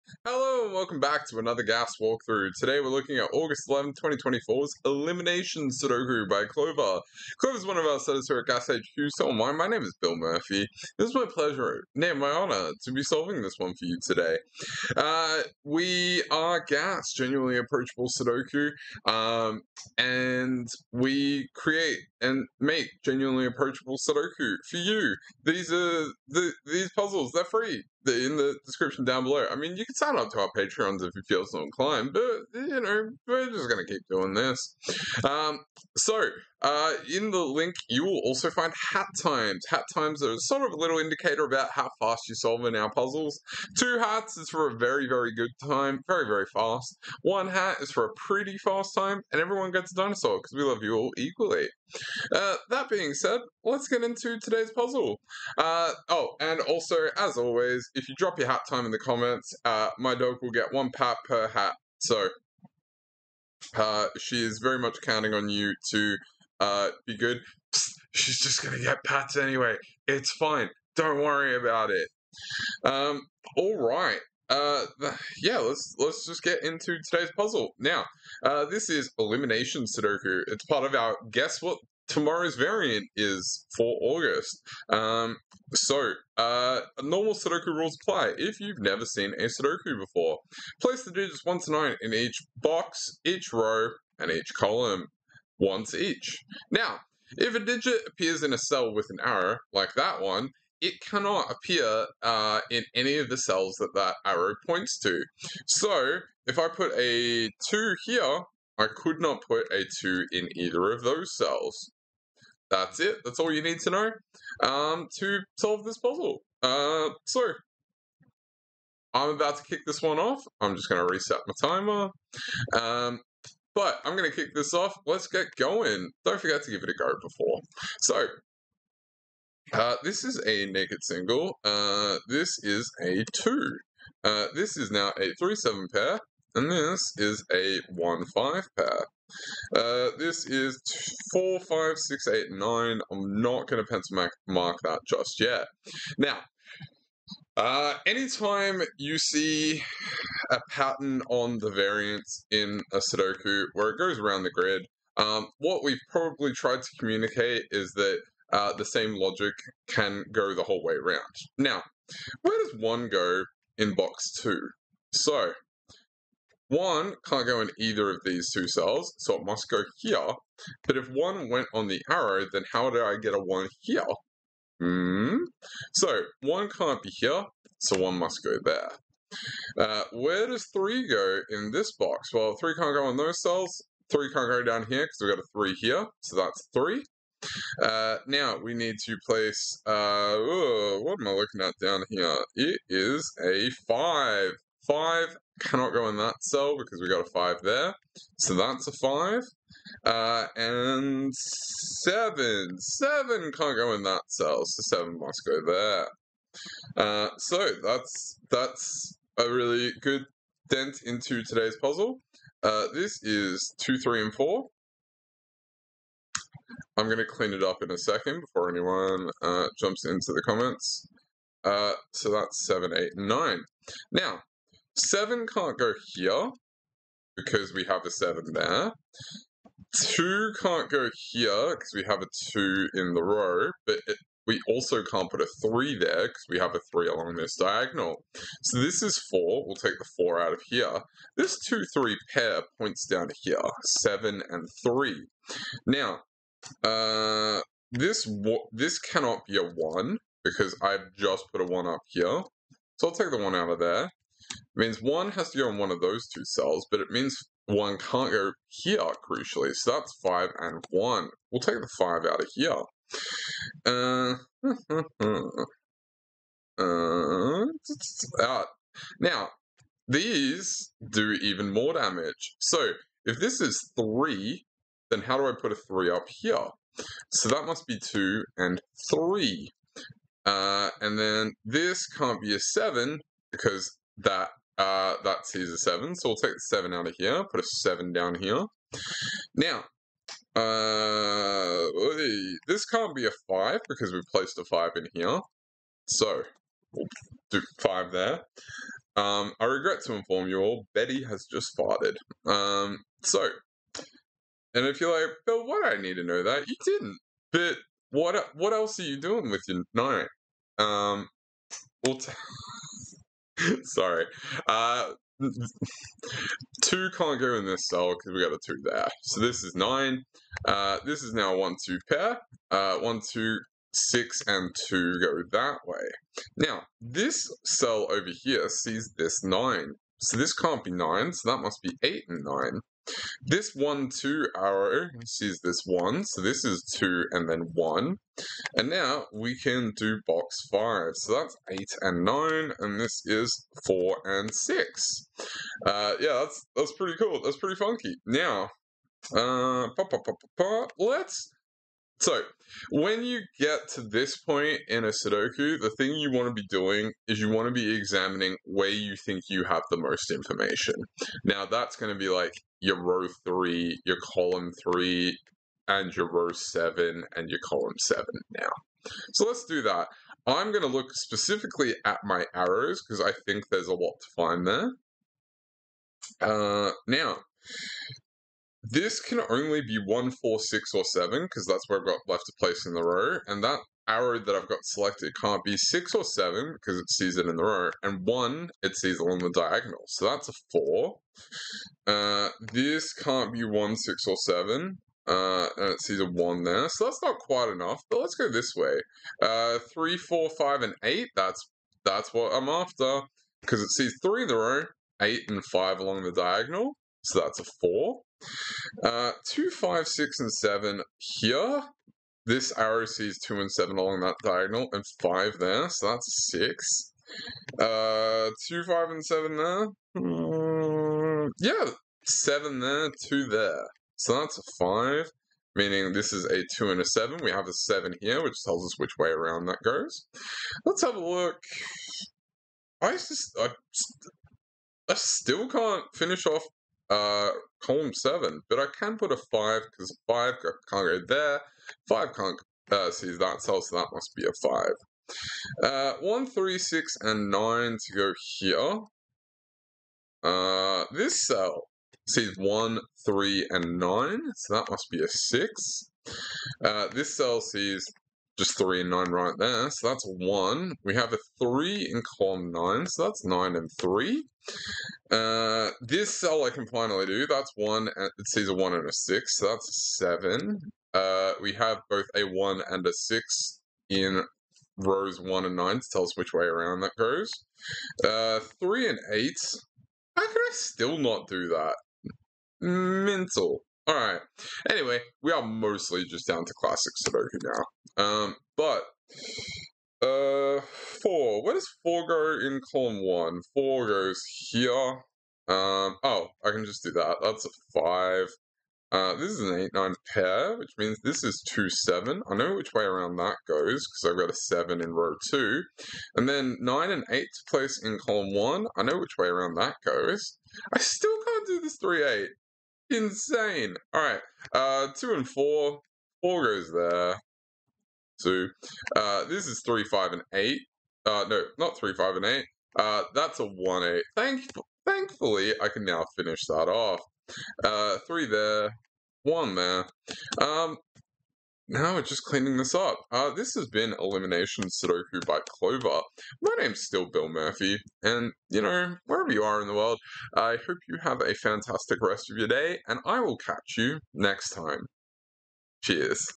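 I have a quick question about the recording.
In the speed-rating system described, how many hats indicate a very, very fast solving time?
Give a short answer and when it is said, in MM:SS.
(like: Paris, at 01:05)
2, at 00:43.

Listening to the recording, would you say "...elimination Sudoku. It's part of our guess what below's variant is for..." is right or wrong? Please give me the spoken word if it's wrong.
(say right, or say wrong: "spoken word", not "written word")
wrong: "tomorrow", not "below".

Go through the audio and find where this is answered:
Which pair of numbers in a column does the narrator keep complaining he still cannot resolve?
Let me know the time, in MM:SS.
08:32.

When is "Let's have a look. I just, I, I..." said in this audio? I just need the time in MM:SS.
07:10.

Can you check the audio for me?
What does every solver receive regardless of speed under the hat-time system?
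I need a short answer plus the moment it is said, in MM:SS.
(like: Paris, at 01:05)
a dinosaur, at 00:49.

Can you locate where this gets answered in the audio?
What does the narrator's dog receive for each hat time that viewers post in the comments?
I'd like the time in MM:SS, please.
01:00.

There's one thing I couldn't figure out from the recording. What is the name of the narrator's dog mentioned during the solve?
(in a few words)
Betty.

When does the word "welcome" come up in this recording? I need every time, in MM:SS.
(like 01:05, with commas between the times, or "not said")
00:00.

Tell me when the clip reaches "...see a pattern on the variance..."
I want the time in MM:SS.
02:29.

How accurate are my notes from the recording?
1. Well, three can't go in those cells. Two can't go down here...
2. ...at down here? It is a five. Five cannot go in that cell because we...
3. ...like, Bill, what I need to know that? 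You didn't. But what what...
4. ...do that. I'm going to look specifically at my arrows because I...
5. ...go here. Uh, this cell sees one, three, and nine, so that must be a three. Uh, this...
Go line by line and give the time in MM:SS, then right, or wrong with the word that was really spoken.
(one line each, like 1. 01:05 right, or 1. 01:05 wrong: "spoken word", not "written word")
1. 03:02 wrong: "Three", not "Two"
2. 03:11 right
3. 05:05 right
4. 06:09 right
5. 07:28 wrong: "six", not "three".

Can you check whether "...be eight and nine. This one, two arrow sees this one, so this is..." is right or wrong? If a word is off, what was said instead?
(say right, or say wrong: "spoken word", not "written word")
right.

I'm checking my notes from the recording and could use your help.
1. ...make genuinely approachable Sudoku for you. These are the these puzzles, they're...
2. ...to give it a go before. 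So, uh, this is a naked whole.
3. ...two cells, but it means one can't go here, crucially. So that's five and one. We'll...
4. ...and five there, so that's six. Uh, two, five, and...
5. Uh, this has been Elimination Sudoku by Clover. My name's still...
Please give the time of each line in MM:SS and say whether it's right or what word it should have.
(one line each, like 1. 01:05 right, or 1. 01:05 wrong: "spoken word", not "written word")
1. 00:22 right
2. 02:06 wrong: "single", not "whole"
3. 04:16 right
4. 06:54 right
5. 08:53 right.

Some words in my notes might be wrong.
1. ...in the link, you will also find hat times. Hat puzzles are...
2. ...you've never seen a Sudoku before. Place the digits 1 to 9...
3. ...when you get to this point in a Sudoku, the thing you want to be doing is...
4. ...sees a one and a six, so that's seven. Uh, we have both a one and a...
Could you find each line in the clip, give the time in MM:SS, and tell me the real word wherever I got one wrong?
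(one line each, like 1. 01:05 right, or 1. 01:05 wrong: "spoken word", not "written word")
1. 00:37 wrong: "times", not "puzzles"
2. 01:28 right
3. 05:52 right
4. 07:48 right.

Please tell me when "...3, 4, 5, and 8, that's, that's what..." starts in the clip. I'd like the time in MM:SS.
06:39.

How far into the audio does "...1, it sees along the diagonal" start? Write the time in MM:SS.
06:28.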